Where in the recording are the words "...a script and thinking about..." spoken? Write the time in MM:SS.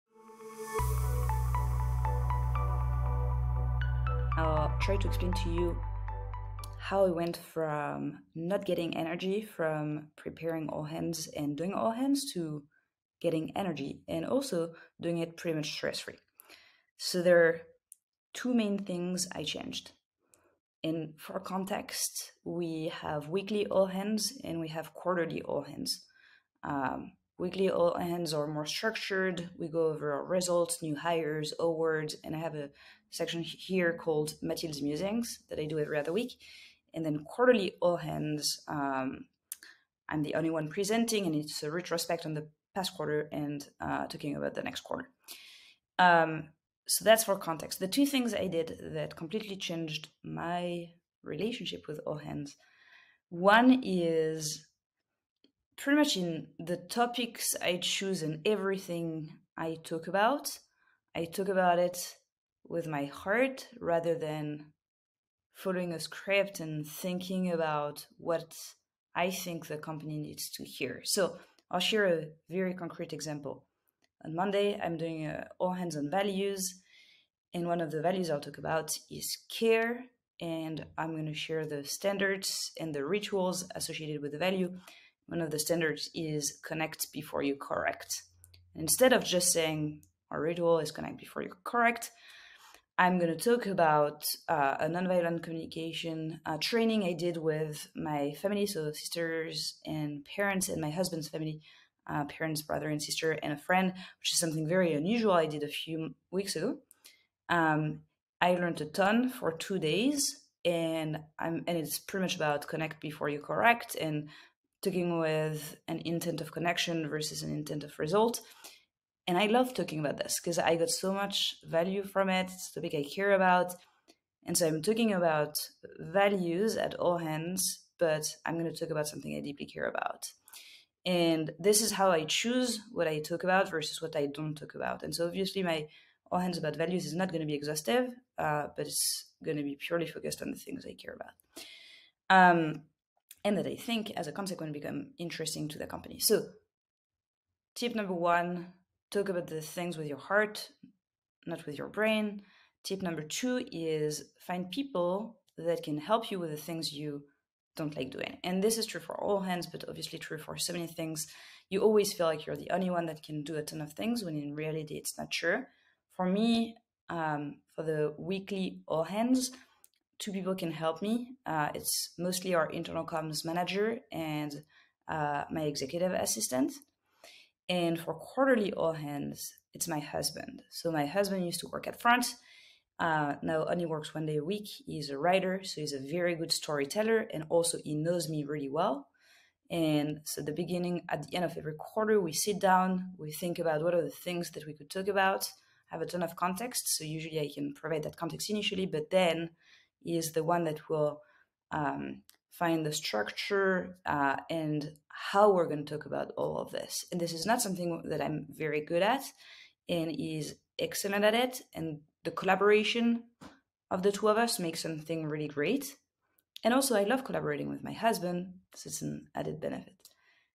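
01:05.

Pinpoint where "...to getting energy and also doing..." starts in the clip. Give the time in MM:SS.
00:12.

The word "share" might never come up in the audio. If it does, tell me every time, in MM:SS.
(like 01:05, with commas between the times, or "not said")
01:11, 01:21.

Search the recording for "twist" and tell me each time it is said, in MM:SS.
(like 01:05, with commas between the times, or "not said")
not said.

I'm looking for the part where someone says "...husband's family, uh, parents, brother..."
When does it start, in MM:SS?
01:40.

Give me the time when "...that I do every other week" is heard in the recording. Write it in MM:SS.
00:35.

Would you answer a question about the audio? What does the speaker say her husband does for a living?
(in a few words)
Writer.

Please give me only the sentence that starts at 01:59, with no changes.
And I love talking about this because I got so much value from it.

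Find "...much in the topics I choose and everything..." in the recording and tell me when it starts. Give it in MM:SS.
00:55.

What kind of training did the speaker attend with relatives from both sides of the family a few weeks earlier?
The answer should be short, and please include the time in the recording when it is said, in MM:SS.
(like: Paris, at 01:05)
Nonviolent communication, at 01:34.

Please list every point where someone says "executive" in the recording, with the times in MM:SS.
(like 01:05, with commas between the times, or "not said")
02:55.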